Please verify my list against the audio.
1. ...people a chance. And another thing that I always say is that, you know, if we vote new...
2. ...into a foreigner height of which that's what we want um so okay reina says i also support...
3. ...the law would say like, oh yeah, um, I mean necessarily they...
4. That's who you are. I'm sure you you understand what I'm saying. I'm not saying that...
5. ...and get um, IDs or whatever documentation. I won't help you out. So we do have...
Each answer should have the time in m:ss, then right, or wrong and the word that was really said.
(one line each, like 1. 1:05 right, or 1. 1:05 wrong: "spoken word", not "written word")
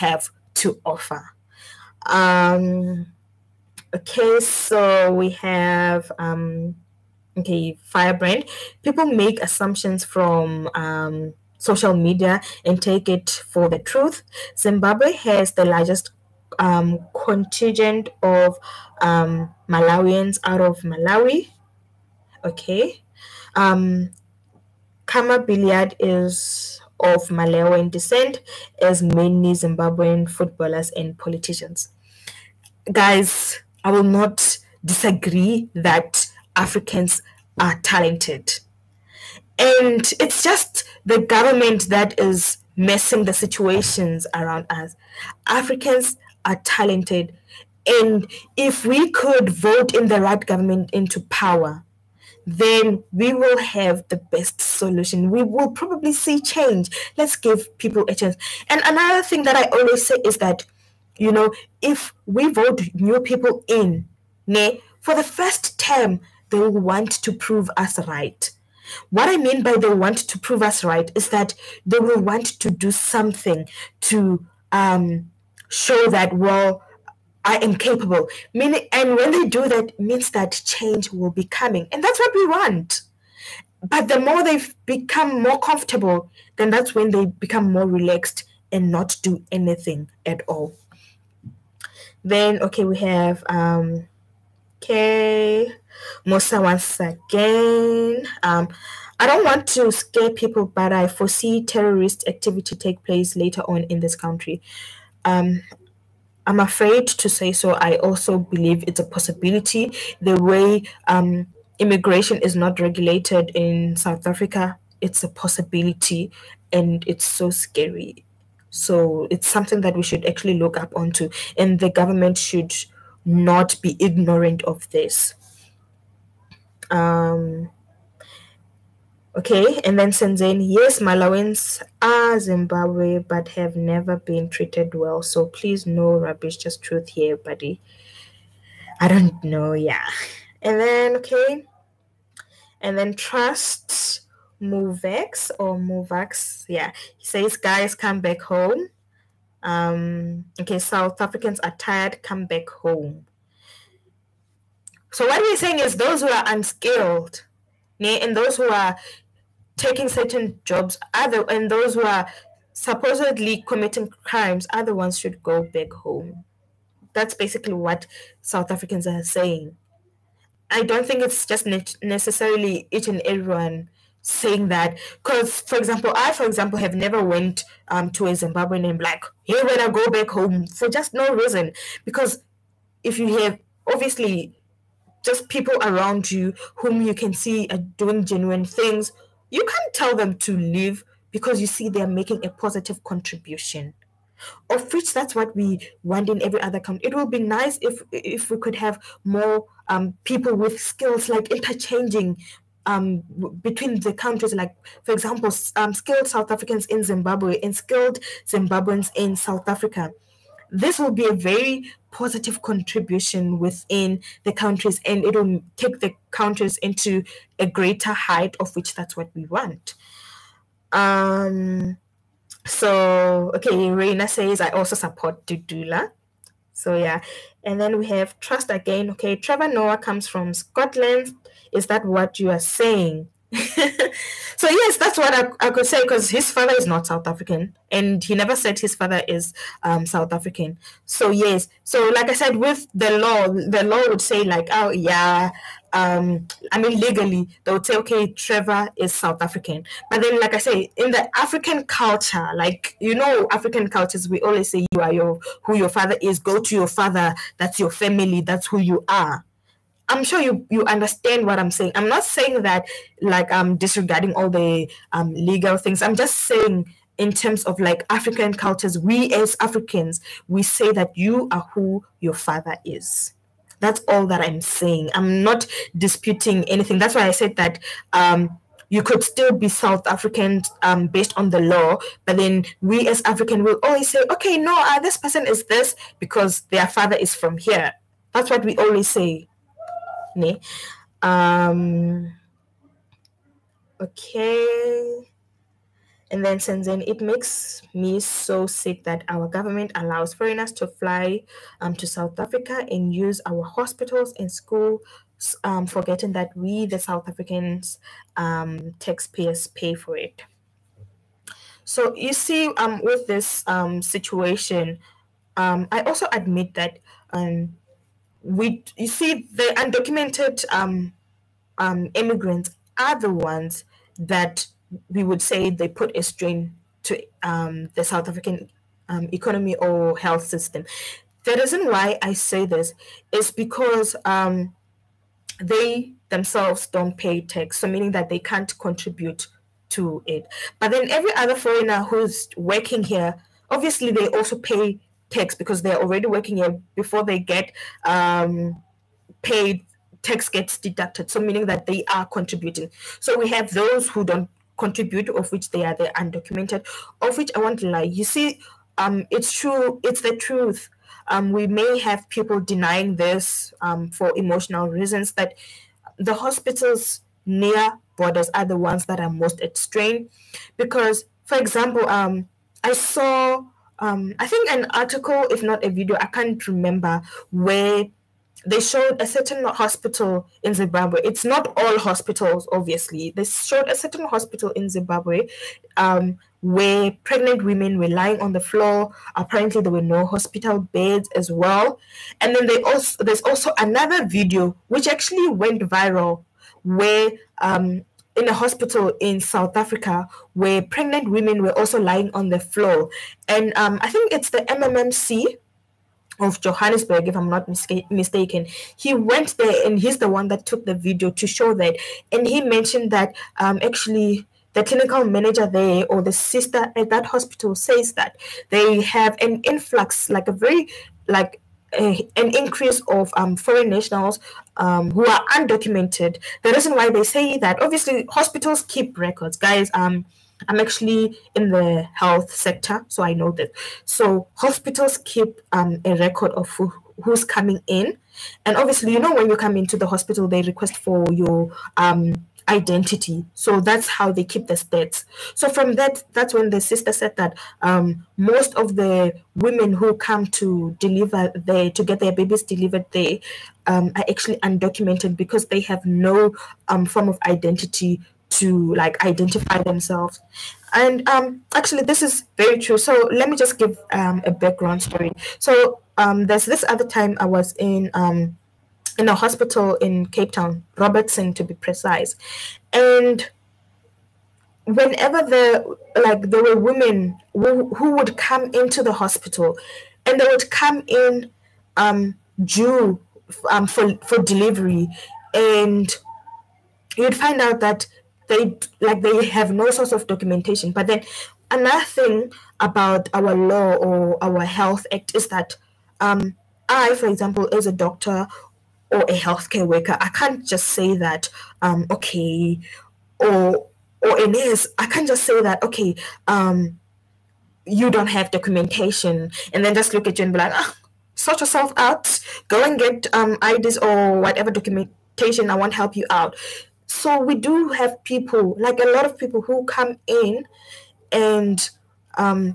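1. 0:57 right
2. 3:36 wrong: "greater", not "foreigner"
3. 4:03 wrong: "legally", not "necessarily"
4. 4:18 right
5. 8:32 right.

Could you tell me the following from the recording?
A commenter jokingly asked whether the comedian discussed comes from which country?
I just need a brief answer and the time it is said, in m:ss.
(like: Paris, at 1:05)
Scotland, at 3:50.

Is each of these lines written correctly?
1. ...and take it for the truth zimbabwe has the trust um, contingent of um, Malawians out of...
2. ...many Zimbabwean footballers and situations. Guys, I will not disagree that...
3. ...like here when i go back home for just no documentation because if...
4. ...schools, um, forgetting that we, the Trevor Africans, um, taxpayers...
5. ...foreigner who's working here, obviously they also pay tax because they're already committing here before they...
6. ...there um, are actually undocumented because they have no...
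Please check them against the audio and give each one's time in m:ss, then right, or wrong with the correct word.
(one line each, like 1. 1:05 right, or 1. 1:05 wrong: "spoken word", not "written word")
1. 0:12 wrong: "largest", not "trust"
2. 0:29 wrong: "politicians", not "situations"
3. 2:58 wrong: "reason", not "documentation"
4. 5:04 wrong: "South", not "Trevor"
5. 5:41 wrong: "working", not "committing"
6. 7:33 right.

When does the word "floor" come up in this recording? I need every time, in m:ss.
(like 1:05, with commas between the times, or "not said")
6:28, 6:42.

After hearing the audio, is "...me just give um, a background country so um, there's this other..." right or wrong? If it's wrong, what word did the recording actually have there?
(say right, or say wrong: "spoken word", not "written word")
wrong: "story", not "country".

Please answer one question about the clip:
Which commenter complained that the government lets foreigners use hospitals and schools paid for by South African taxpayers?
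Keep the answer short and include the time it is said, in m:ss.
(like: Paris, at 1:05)
Senzeni, at 4:56.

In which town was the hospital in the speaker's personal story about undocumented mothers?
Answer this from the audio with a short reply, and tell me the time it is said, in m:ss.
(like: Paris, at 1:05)
Robertson, at 7:50.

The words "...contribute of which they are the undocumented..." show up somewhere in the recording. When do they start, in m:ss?
5:54.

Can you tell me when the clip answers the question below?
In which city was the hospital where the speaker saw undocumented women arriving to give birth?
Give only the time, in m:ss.
7:50.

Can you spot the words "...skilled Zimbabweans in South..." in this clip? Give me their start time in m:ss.
3:27.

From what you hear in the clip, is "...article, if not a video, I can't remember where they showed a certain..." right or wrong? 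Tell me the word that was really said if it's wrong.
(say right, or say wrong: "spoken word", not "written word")
right.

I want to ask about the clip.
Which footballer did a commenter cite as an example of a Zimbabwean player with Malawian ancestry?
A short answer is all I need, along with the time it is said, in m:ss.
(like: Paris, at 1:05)
Khama Billiat, at 0:25.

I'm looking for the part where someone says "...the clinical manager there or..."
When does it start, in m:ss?
6:54.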